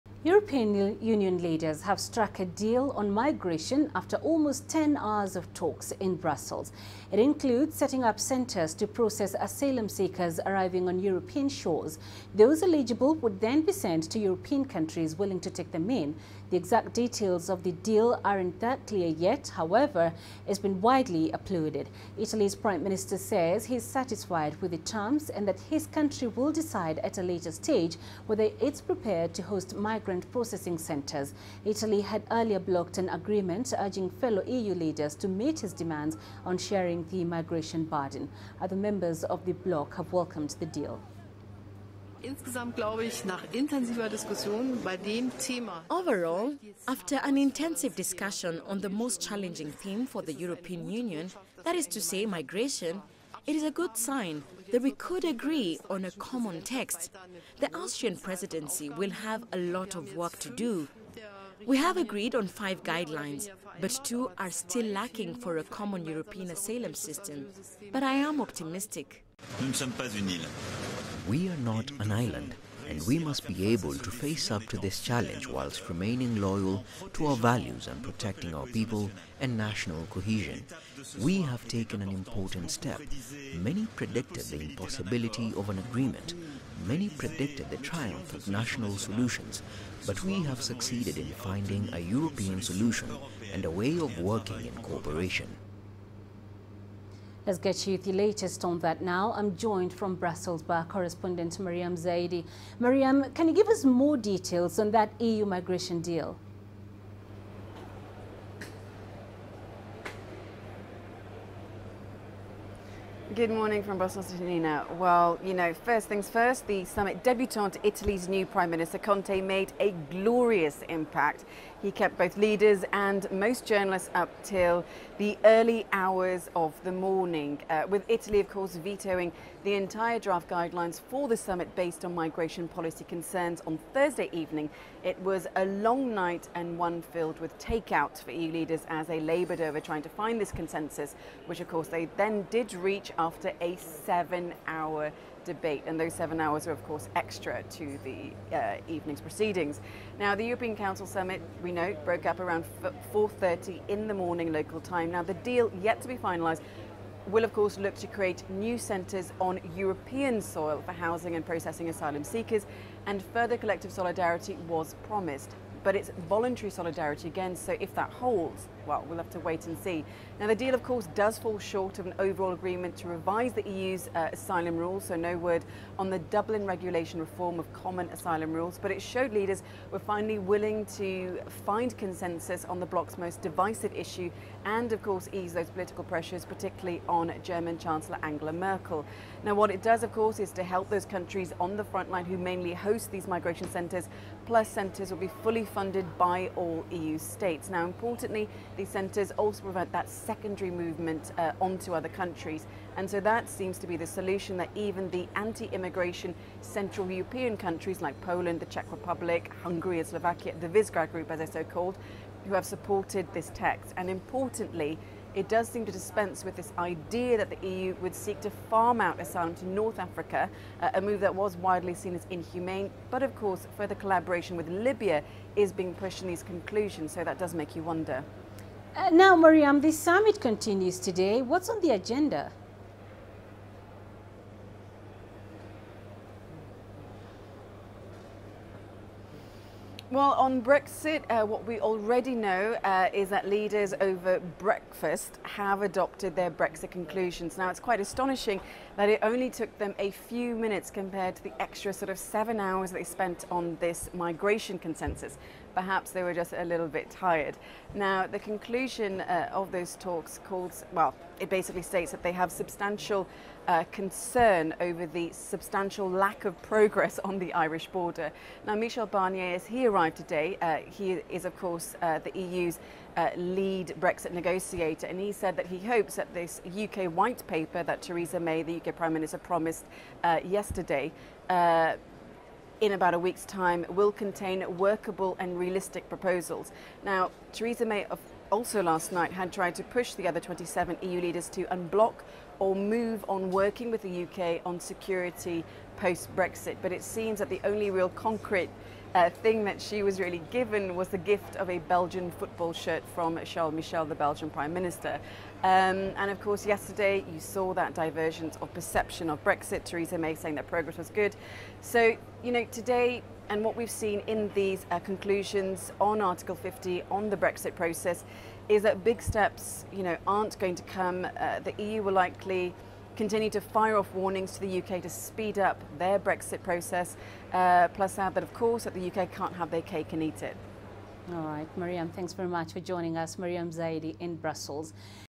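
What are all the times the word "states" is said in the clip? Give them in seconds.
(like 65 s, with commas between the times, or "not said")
197 s, 261 s.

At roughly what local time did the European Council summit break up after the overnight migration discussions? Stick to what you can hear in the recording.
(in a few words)
4:30 in the morning.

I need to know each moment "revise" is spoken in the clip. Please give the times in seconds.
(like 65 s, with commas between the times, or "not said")
173 s.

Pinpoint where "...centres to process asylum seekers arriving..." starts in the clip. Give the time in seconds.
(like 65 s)
8 s.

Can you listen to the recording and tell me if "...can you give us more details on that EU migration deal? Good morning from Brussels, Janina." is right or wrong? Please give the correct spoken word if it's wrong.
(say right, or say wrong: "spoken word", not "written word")
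right.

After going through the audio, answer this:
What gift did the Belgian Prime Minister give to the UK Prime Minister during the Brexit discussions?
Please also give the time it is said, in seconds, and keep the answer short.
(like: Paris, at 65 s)
a Belgian football shirt, at 301 s.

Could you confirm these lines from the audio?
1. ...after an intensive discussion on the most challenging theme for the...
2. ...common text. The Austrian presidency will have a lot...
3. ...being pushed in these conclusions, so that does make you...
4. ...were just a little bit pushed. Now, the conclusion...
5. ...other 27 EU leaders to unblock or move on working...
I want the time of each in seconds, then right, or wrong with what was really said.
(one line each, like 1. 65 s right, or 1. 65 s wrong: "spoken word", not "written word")
1. 46 s right
2. 56 s right
3. 225 s right
4. 256 s wrong: "tired", not "pushed"
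5. 290 s right.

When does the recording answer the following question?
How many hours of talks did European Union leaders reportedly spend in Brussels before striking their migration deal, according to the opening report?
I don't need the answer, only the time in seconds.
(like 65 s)
4 s.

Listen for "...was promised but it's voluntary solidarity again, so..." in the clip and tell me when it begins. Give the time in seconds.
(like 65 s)
164 s.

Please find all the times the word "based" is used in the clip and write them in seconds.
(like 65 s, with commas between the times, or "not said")
131 s.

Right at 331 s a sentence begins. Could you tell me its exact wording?
All right, Mariam, thanks very much for joining us.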